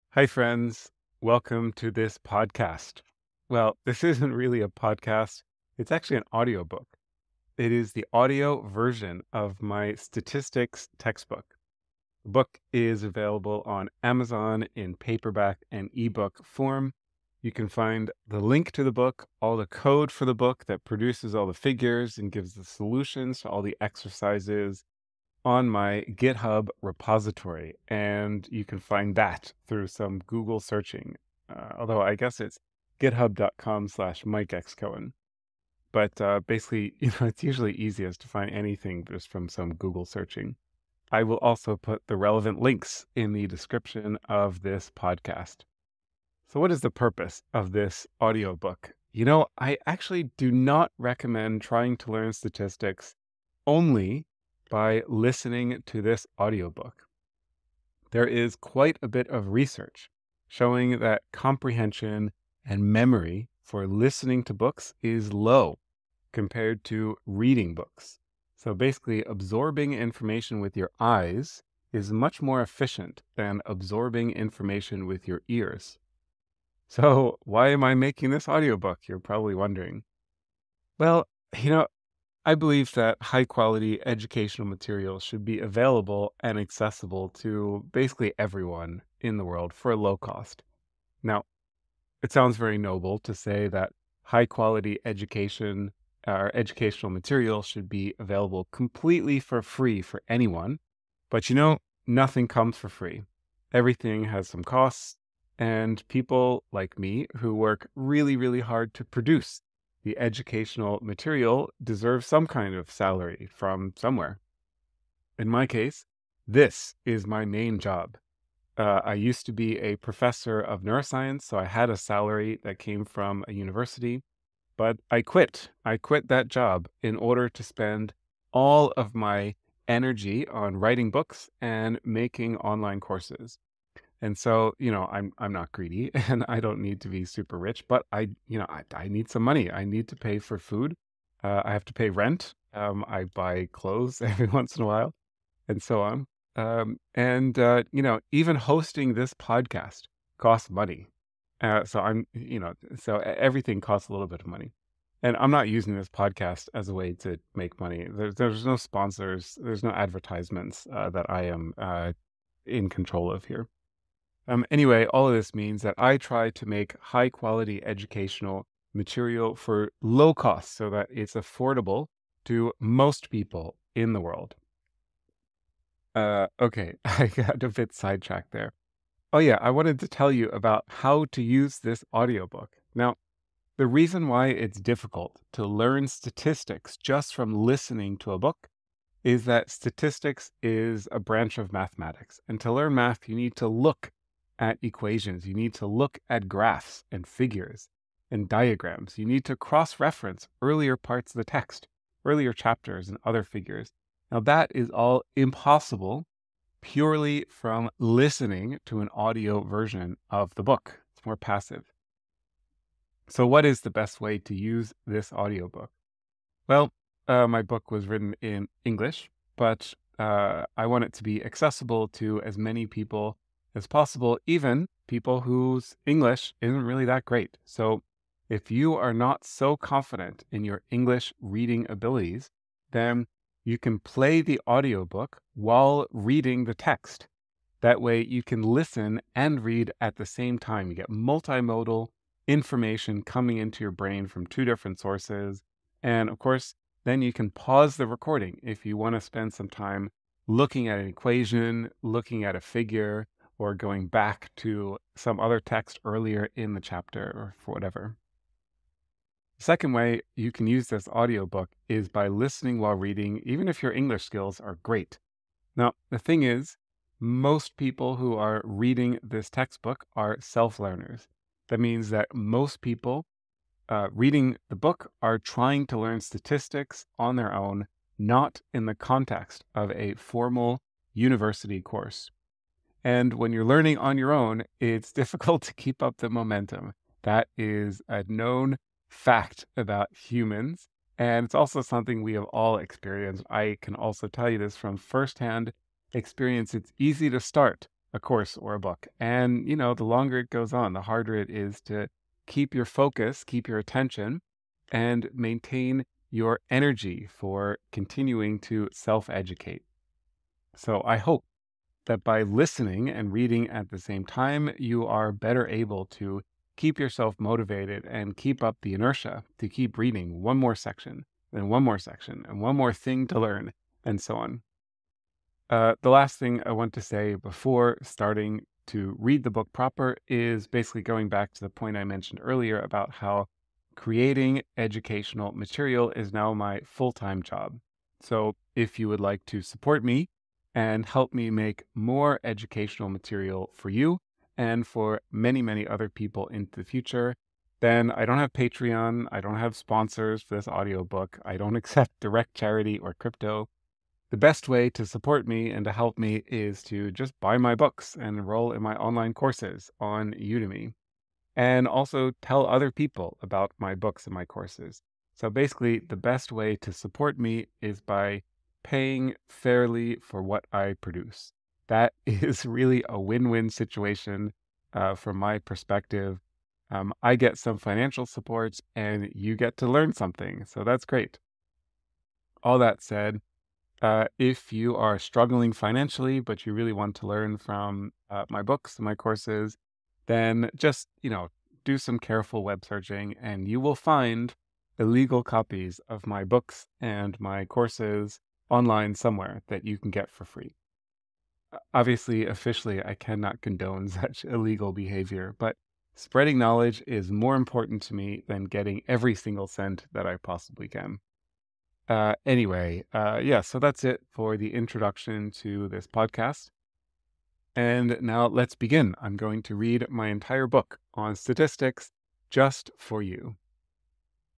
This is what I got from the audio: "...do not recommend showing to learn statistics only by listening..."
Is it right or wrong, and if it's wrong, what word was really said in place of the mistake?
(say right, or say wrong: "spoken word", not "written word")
wrong: "trying", not "showing".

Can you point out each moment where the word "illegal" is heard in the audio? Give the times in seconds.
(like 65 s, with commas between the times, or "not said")
394 s, 404 s.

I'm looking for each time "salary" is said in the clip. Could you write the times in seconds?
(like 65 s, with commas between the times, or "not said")
112 s, 121 s.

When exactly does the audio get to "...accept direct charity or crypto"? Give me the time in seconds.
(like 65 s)
351 s.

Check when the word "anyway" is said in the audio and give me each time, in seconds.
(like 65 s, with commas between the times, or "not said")
164 s, 412 s.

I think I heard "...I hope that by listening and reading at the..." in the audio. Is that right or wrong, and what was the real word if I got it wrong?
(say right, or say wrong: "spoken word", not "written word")
right.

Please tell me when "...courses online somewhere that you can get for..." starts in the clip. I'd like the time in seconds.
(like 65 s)
397 s.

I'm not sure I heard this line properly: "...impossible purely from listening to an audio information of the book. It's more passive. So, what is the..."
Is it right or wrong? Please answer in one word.
wrong.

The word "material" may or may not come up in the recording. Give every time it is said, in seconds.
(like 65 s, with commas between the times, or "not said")
84 s, 97 s, 111 s, 168 s, 335 s, 343 s.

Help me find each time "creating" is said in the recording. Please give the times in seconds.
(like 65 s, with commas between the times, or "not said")
333 s.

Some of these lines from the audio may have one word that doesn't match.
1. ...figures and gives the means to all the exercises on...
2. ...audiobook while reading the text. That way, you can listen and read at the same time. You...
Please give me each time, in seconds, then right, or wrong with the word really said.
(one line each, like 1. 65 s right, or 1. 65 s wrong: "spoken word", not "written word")
1. 21 s wrong: "solutions", not "means"
2. 234 s right.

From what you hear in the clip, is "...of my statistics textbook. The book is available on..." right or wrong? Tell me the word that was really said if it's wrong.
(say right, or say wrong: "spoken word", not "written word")
right.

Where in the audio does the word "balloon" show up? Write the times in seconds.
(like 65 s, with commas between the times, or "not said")
not said.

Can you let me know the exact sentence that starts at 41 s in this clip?
I will also put the relevant links in the description of this podcast.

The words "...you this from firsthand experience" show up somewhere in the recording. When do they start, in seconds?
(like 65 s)
294 s.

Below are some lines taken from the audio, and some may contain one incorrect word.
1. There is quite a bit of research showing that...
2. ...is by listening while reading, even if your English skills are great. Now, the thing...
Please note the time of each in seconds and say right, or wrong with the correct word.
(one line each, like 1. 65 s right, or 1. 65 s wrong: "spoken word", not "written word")
1. 58 s right
2. 261 s right.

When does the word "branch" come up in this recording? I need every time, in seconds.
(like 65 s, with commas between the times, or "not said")
191 s.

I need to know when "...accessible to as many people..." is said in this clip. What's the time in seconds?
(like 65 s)
221 s.